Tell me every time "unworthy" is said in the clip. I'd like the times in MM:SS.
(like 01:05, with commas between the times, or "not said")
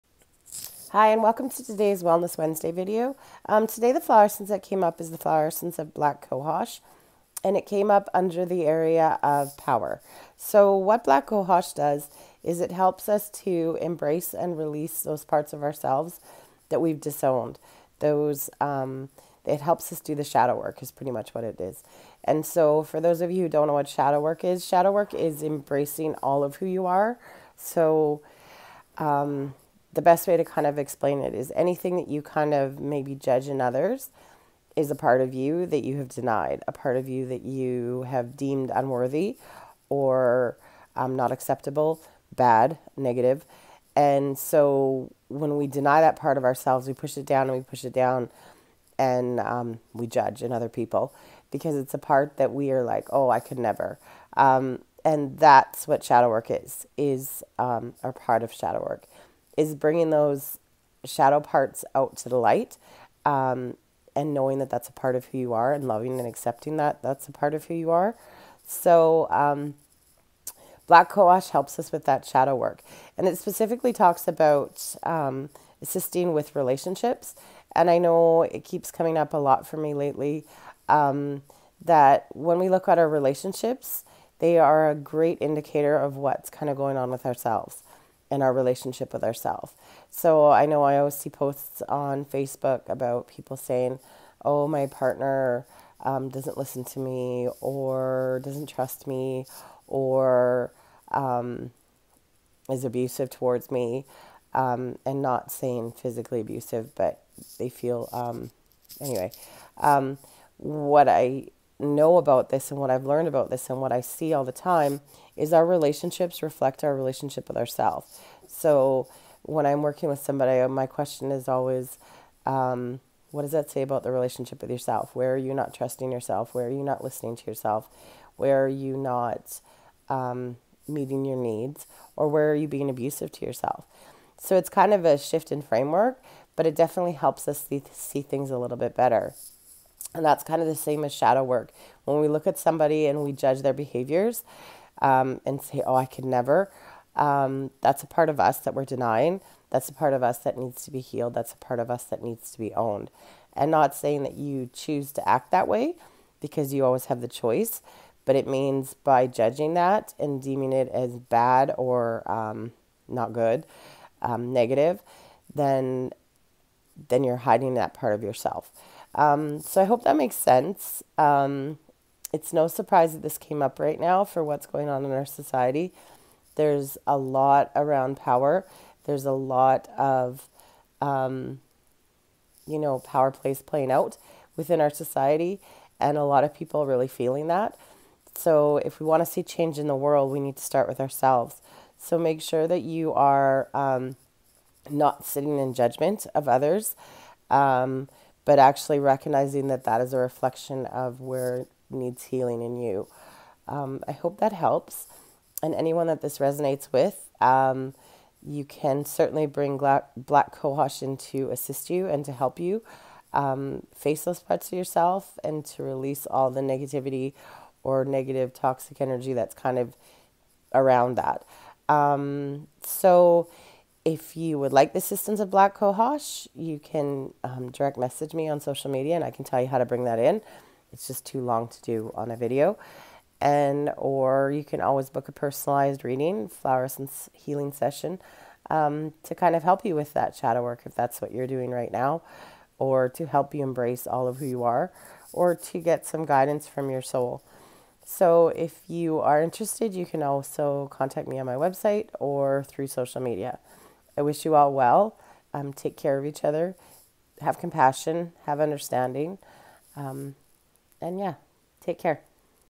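00:38.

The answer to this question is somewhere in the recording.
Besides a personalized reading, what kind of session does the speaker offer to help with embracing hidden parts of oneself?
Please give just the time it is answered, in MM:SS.
03:56.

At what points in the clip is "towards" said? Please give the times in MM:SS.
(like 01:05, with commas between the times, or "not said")
01:43.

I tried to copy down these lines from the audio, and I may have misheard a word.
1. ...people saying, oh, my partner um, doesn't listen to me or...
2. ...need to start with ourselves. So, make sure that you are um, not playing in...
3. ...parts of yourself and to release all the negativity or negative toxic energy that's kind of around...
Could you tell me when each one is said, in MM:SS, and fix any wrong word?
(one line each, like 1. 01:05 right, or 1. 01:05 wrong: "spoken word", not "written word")
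1. 01:33 right
2. 03:10 wrong: "sitting", not "playing"
3. 03:34 right.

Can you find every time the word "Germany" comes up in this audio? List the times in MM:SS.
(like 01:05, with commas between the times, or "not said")
not said.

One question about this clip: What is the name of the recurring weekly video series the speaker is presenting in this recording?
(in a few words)
Wellness Wednesday.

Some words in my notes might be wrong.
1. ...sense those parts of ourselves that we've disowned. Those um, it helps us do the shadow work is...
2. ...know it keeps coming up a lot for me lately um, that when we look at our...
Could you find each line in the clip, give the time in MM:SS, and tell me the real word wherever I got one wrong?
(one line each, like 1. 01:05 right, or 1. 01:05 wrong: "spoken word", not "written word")
1. 00:14 wrong: "release", not "sense"
2. 01:17 right.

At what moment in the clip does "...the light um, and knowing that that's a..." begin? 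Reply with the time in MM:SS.
01:02.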